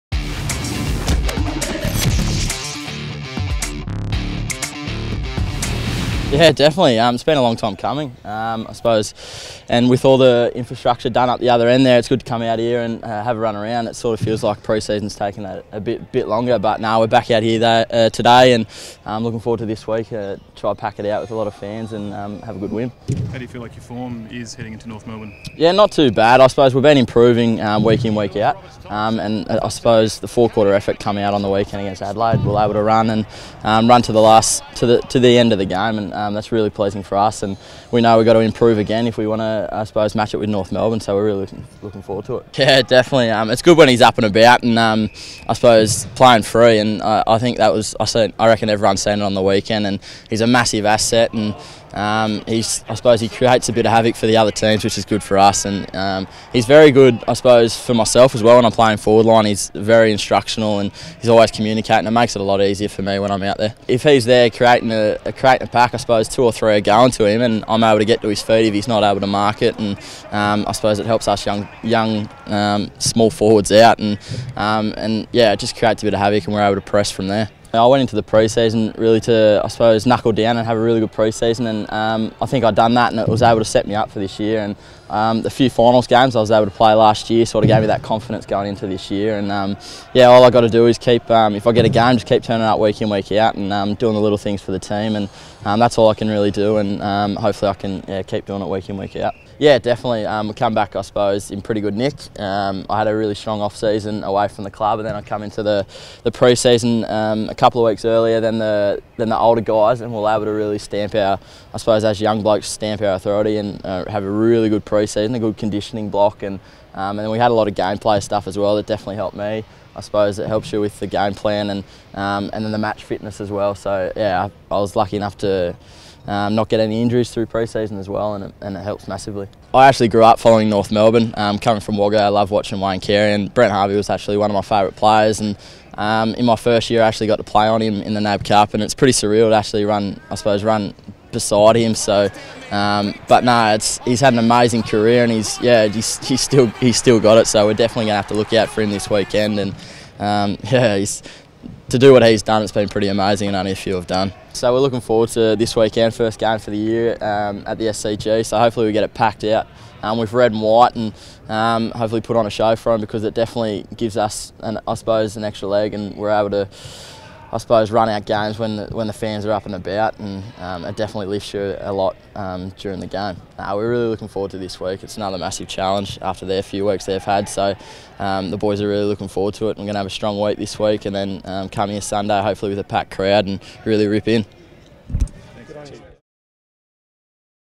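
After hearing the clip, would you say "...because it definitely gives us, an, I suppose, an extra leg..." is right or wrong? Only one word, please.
right.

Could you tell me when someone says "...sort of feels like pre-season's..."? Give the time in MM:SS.
00:13.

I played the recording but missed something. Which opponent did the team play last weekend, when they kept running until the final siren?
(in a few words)
Adelaide.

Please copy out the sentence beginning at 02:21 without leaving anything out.
So, um, but no, it's he's had an amazing career, and he's yeah, he's, he's still he's still got it.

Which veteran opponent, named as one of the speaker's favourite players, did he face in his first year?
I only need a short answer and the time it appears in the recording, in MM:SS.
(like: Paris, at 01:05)
Brent Harvey, at 02:13.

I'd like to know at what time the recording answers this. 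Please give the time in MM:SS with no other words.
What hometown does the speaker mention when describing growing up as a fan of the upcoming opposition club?
02:11.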